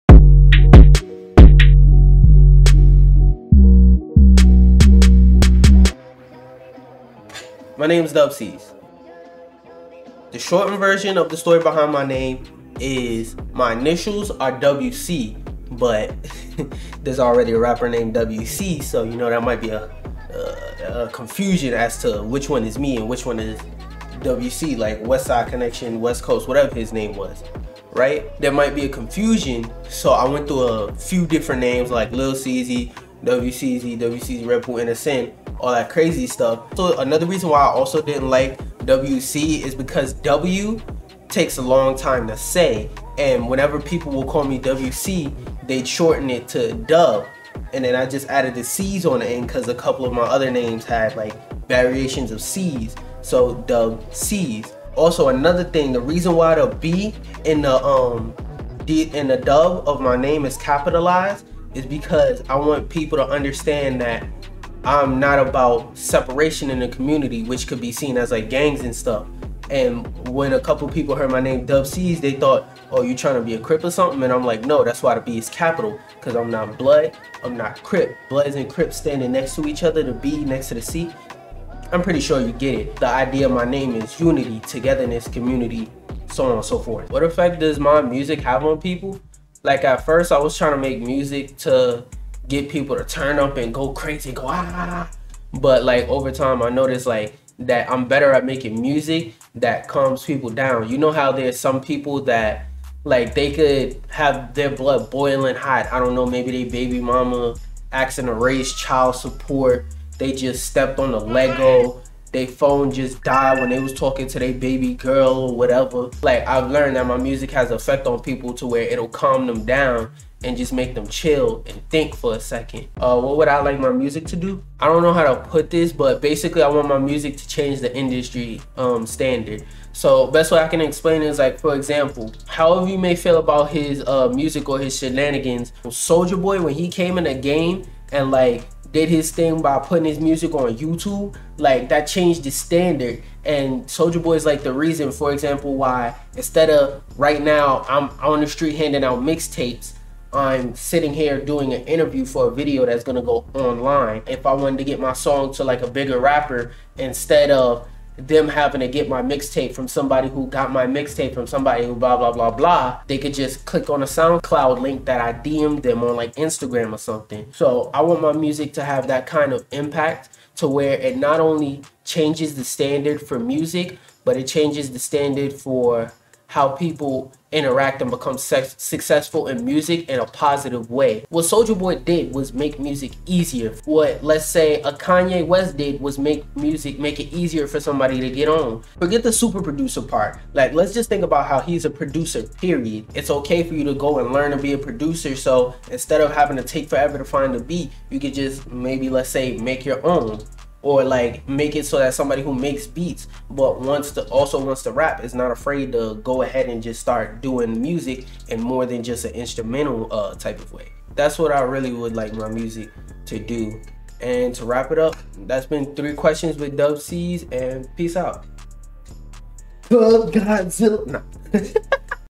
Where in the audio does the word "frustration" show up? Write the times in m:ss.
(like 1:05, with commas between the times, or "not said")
not said.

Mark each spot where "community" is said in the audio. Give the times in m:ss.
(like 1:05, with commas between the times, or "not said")
1:06, 1:25.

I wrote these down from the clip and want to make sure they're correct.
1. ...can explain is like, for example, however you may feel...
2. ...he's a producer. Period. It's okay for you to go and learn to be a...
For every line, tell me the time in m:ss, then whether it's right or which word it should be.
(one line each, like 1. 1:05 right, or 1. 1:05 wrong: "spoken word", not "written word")
1. 2:10 right
2. 3:11 right.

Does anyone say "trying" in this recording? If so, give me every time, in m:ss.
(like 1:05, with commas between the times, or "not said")
1:13, 1:30.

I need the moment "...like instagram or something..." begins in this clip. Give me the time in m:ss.
2:46.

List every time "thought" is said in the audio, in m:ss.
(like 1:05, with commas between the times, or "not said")
1:12.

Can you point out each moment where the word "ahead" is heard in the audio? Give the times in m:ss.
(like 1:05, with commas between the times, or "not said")
3:26.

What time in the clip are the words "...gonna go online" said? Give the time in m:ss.
2:33.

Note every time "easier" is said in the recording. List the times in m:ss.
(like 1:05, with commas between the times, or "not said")
3:03, 3:07.